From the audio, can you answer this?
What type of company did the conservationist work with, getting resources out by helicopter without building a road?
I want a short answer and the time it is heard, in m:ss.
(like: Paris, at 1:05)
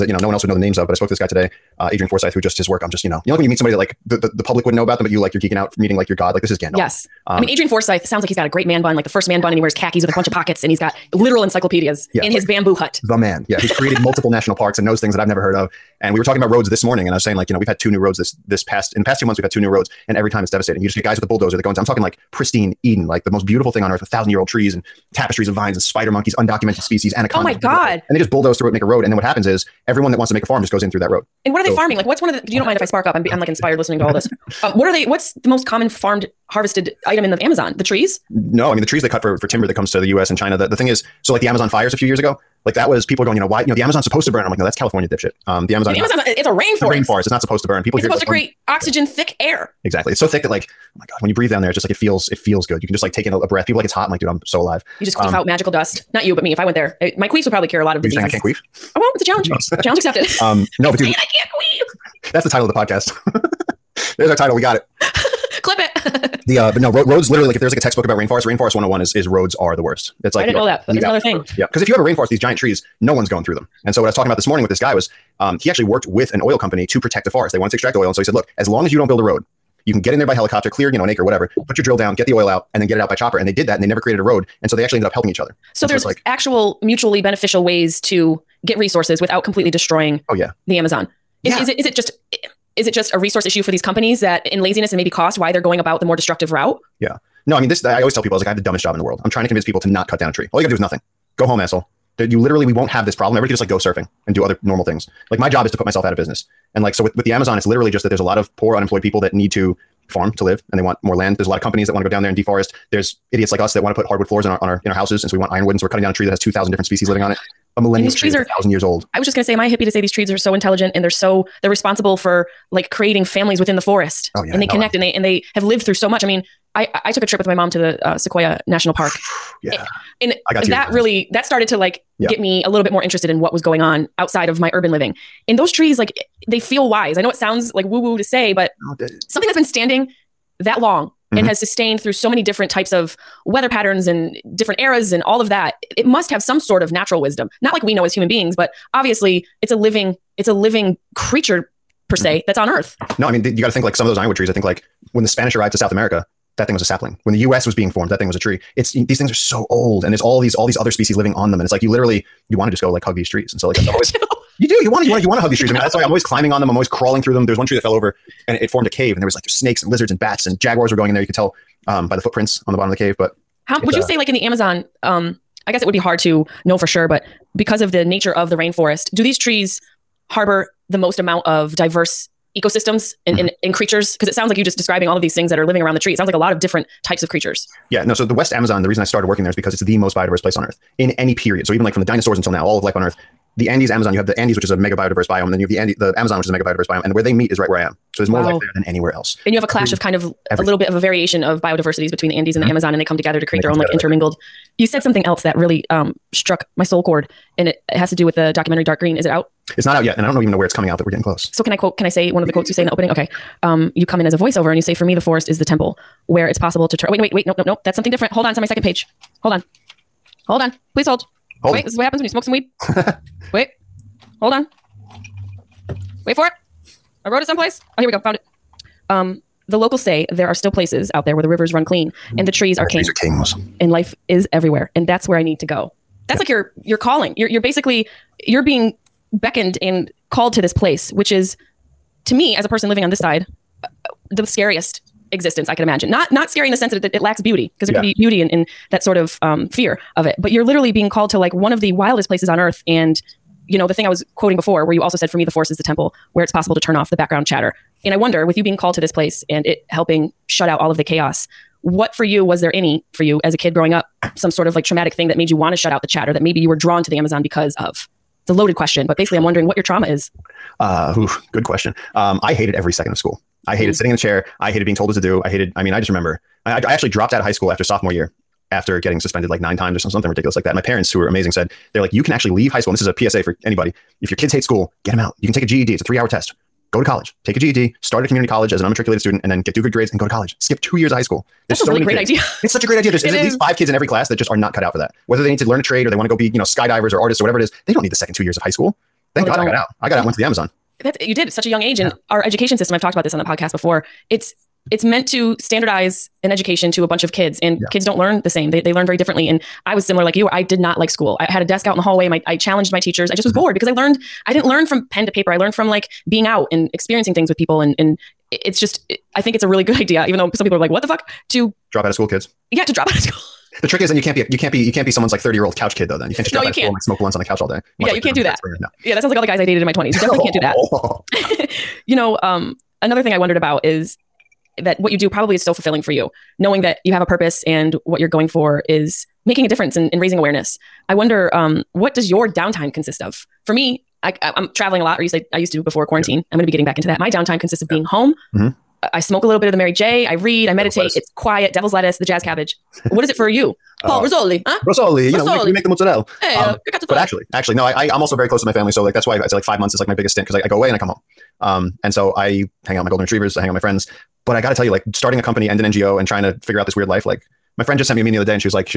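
An oil company, at 1:16.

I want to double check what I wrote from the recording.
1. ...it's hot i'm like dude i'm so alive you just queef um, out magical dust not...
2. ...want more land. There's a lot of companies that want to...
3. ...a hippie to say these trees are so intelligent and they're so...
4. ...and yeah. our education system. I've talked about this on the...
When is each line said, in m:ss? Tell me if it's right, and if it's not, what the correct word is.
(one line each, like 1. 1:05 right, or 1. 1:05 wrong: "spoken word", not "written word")
1. 0:53 right
2. 1:50 right
3. 1:59 right
4. 5:01 right.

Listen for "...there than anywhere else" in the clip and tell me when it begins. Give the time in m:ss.
3:18.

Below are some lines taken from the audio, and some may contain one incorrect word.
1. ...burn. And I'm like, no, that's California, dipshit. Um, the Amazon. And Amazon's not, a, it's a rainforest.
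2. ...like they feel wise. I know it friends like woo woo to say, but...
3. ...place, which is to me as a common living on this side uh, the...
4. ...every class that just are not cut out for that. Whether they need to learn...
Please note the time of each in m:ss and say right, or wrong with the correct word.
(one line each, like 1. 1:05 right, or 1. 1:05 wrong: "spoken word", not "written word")
1. 0:44 right
2. 2:15 wrong: "sounds", not "friends"
3. 4:00 wrong: "person", not "common"
4. 4:53 right.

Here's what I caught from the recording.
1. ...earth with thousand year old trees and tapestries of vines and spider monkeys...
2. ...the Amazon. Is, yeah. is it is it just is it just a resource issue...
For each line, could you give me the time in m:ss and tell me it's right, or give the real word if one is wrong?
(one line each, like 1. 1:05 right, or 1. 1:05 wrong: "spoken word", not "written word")
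1. 0:23 right
2. 1:30 right.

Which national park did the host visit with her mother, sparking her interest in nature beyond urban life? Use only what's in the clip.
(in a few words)
Sequoia National Park.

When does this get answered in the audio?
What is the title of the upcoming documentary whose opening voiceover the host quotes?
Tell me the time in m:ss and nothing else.
3:28.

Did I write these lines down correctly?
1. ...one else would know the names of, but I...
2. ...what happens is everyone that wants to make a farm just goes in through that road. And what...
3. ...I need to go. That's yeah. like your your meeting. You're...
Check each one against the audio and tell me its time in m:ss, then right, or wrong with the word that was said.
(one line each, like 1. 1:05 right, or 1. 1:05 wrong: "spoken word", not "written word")
1. 0:00 right
2. 0:29 right
3. 3:55 wrong: "calling", not "meeting".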